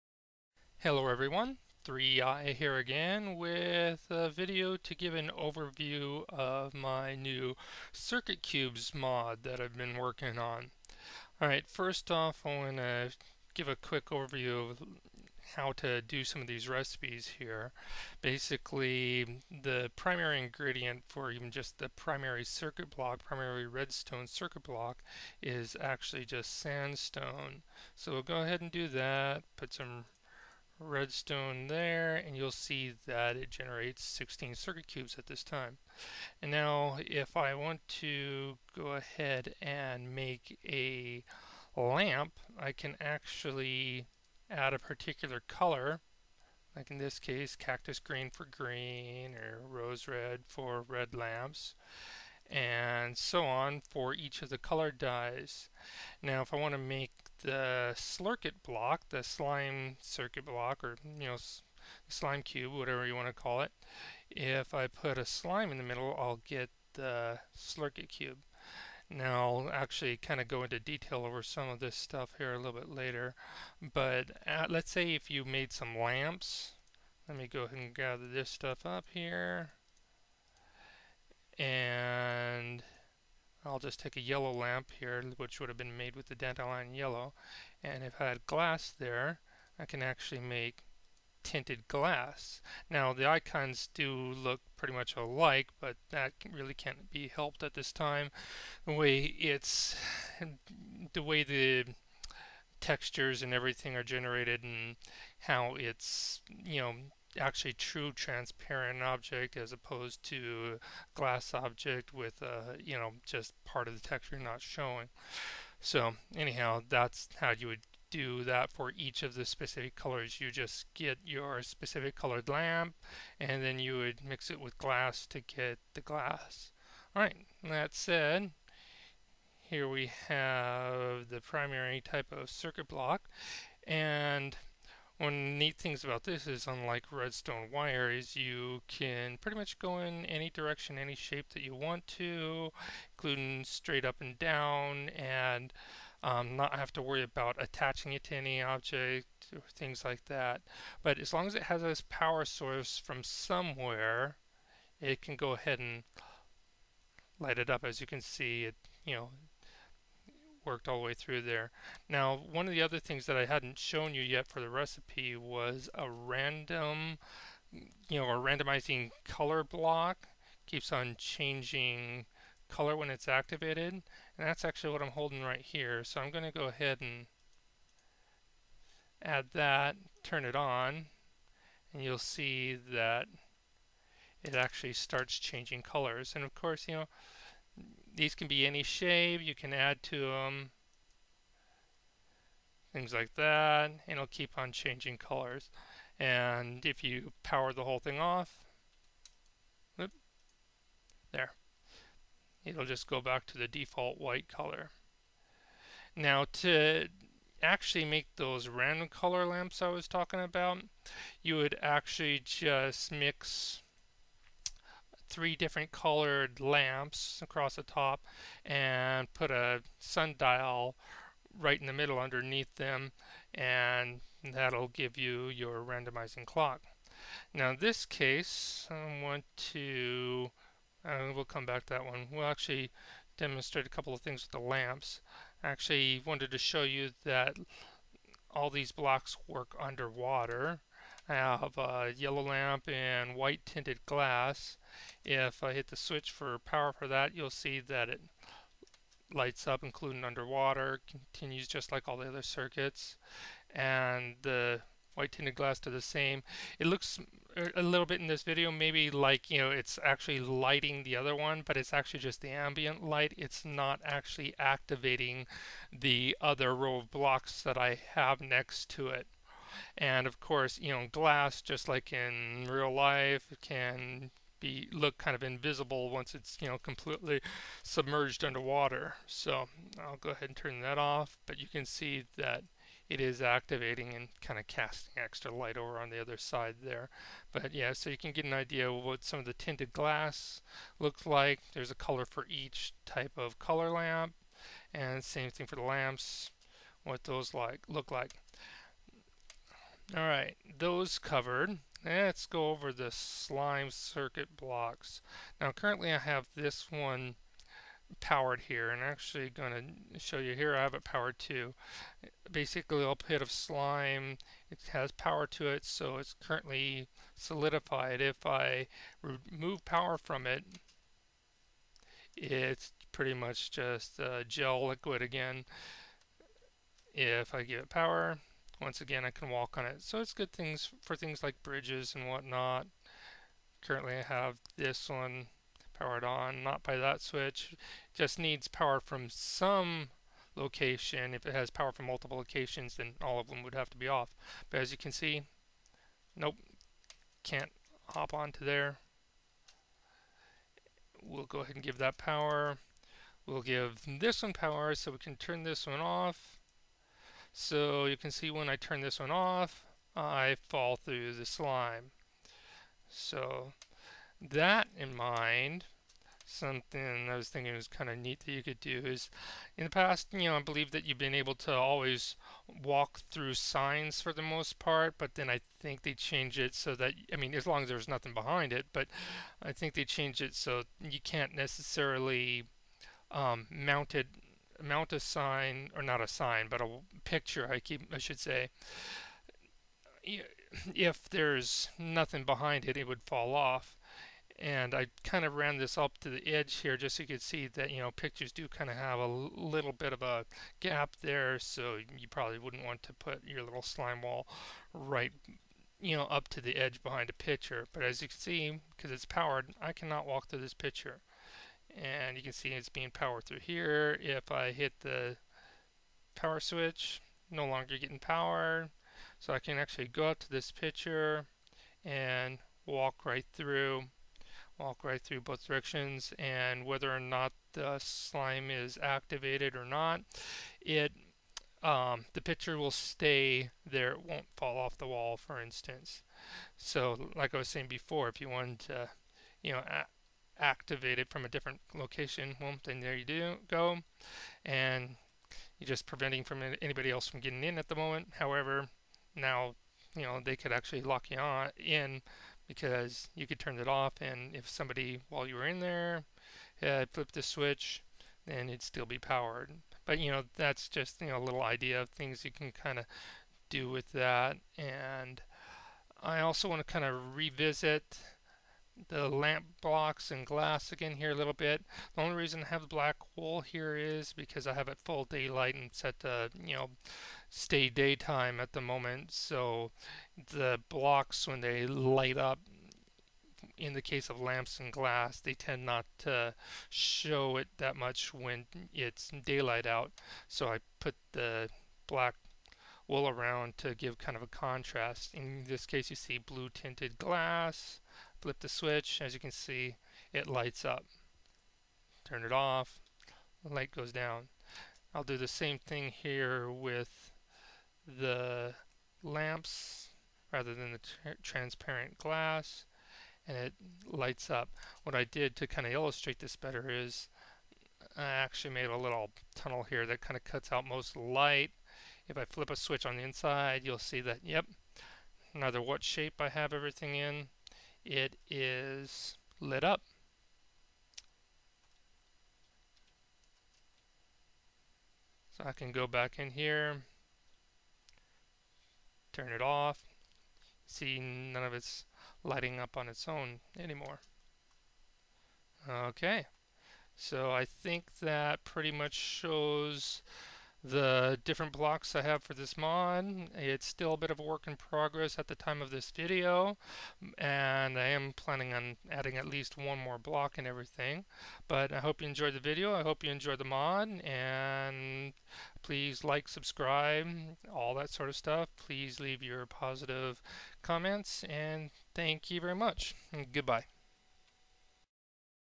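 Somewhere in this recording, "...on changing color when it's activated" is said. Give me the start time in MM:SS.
02:50.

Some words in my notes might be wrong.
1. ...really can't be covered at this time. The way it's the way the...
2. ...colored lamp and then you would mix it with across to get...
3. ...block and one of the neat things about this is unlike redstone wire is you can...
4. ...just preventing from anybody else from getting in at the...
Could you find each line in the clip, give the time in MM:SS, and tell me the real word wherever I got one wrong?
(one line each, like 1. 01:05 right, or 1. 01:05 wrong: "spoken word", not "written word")
1. 01:36 wrong: "helped", not "covered"
2. 02:02 wrong: "glass", not "across"
3. 02:12 right
4. 07:25 right.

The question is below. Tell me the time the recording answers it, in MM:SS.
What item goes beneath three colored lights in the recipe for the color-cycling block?
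03:39.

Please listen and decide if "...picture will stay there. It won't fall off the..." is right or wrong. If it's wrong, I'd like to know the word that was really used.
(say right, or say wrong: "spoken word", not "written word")
right.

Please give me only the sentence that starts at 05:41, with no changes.
If it has power from multiple locations, then all of them would have to be off.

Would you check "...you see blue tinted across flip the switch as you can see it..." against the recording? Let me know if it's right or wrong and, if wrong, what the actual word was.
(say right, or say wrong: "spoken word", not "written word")
wrong: "glass", not "across".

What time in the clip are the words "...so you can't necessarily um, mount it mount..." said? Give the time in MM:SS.
06:20.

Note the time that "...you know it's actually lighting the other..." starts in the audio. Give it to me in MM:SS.
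04:19.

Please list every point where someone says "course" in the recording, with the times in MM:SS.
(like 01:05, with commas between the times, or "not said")
03:06, 04:30.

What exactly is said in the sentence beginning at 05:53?
We'll give this one power so we can turn this one off.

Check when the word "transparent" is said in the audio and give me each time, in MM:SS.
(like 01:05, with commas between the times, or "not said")
01:48, 08:31.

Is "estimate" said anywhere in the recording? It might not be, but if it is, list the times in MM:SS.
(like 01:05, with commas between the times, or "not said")
not said.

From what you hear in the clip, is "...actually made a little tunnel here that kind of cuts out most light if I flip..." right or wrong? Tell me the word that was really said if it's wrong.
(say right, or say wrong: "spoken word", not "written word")
right.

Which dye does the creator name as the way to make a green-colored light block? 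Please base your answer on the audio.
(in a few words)
Cactus green.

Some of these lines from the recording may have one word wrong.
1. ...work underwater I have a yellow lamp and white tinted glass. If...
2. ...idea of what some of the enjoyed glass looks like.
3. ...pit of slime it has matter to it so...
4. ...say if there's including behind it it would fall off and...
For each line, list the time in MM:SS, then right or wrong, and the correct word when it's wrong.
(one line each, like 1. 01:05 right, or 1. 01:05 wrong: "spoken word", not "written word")
1. 03:59 right
2. 04:48 wrong: "tinted", not "enjoyed"
3. 05:13 wrong: "power", not "matter"
4. 06:28 wrong: "nothing", not "including".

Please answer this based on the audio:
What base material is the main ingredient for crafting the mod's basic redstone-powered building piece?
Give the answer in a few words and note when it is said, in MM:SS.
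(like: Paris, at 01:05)
Sandstone, at 00:26.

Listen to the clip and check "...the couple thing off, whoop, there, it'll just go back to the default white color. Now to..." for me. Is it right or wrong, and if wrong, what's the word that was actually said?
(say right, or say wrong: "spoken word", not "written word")
wrong: "whole", not "couple".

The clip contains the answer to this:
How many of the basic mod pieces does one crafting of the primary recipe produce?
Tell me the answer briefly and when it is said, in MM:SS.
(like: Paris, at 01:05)
16, at 00:34.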